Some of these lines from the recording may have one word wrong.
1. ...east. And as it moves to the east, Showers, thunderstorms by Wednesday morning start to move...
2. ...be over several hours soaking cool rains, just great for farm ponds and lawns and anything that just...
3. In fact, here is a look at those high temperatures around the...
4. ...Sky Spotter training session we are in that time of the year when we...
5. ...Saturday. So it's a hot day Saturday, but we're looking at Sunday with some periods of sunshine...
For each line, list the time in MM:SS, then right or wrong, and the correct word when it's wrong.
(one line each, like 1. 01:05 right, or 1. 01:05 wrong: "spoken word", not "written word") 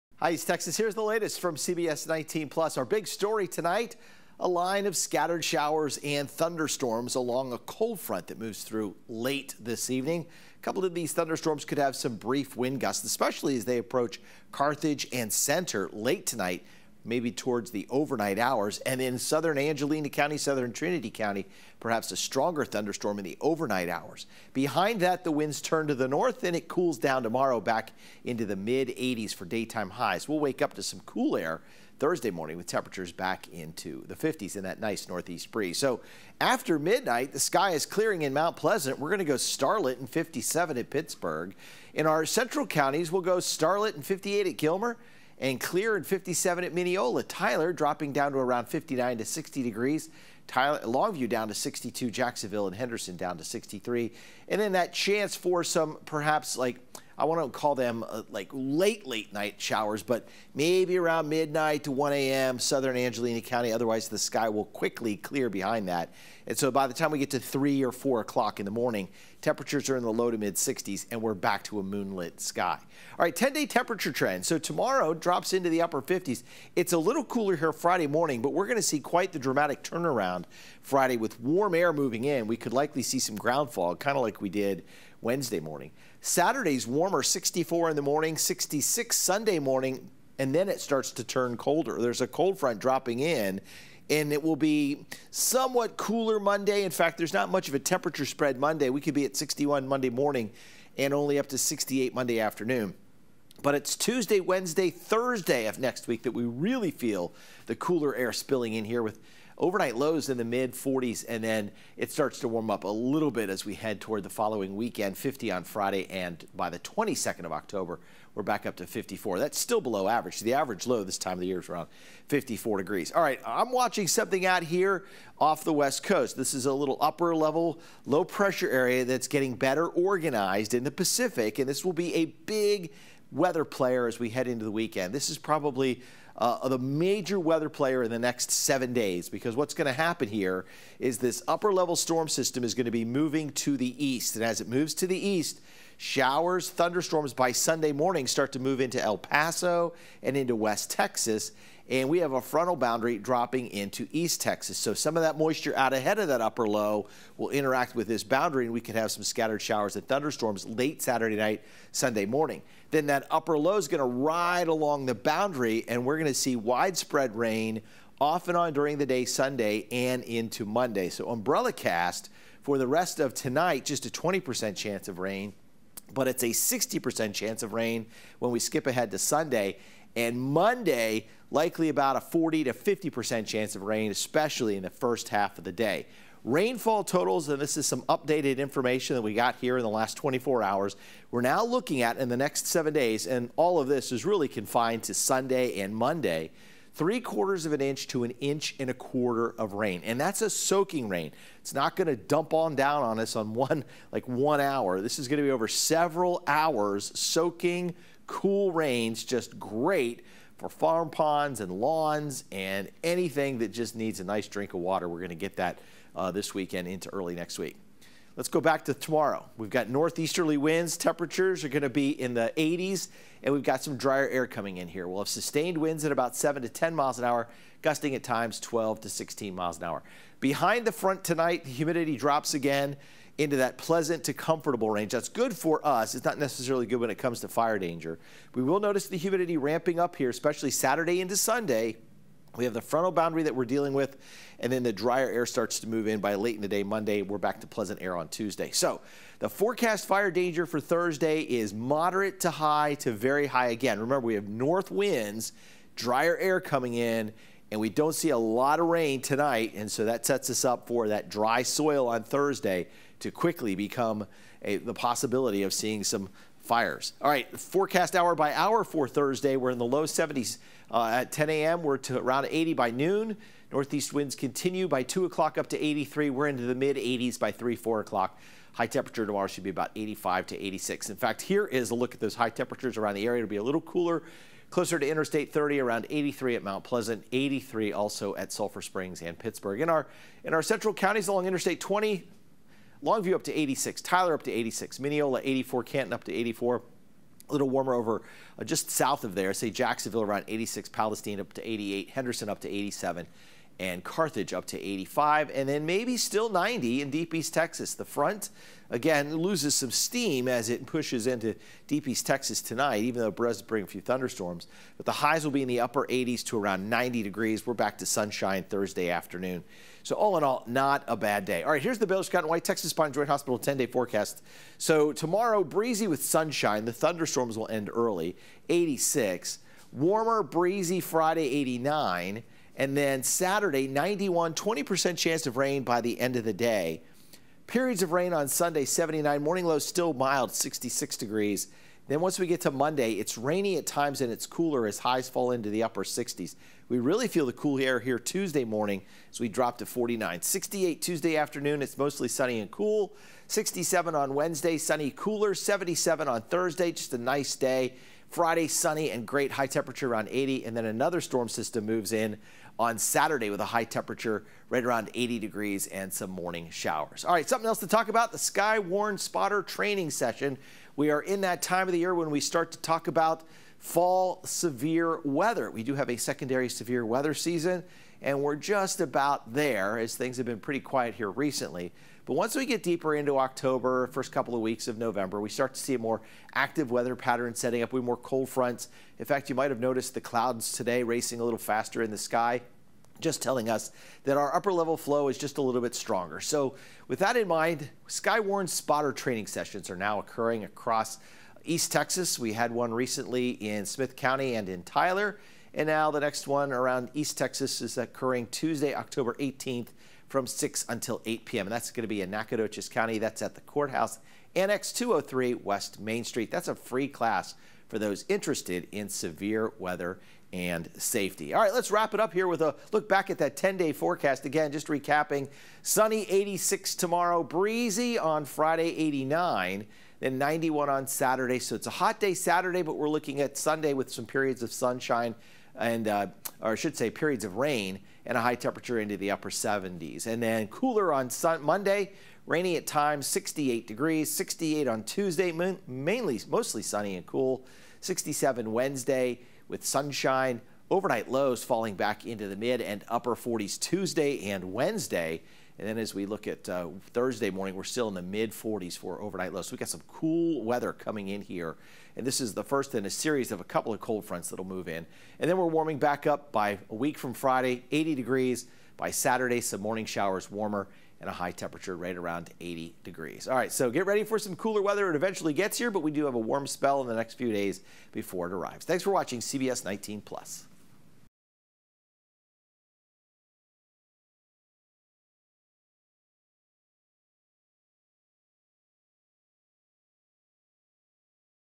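1. 02:24 wrong: "Sunday", not "Wednesday"
2. 03:25 right
3. 04:41 right
4. 06:08 right
5. 07:11 right.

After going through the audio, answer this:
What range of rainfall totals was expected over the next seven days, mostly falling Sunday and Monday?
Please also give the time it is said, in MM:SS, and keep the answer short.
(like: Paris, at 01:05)
3/4 inch to 1 1/4 inch, at 03:16.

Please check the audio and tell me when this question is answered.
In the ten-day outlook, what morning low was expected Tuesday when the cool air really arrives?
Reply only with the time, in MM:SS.
05:49.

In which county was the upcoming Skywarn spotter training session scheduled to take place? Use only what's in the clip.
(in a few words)
Nacogdoches County.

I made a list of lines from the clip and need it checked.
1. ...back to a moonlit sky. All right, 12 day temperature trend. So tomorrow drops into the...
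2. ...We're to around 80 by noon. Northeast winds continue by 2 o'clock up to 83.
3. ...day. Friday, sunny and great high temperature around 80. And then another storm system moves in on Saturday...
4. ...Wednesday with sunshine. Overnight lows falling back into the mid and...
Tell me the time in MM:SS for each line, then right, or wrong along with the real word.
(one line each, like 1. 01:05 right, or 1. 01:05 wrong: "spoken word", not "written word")
1. 01:11 wrong: "10", not "12"
2. 04:31 right
3. 05:57 right
4. 07:28 right.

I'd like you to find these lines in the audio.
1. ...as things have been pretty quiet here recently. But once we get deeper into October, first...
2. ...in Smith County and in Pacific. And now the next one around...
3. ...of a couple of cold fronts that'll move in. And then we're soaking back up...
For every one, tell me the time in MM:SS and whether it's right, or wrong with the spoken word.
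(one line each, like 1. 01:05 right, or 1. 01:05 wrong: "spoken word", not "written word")
1. 06:19 right
2. 06:43 wrong: "Tyler", not "Pacific"
3. 07:43 wrong: "warming", not "soaking".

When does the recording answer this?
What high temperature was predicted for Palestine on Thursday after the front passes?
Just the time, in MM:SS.
05:00.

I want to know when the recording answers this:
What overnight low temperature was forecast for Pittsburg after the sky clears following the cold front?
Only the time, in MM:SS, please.
00:39.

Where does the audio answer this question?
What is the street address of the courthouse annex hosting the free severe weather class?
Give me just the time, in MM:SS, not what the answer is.
06:54.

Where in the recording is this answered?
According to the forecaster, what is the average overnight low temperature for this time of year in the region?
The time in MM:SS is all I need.
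02:01.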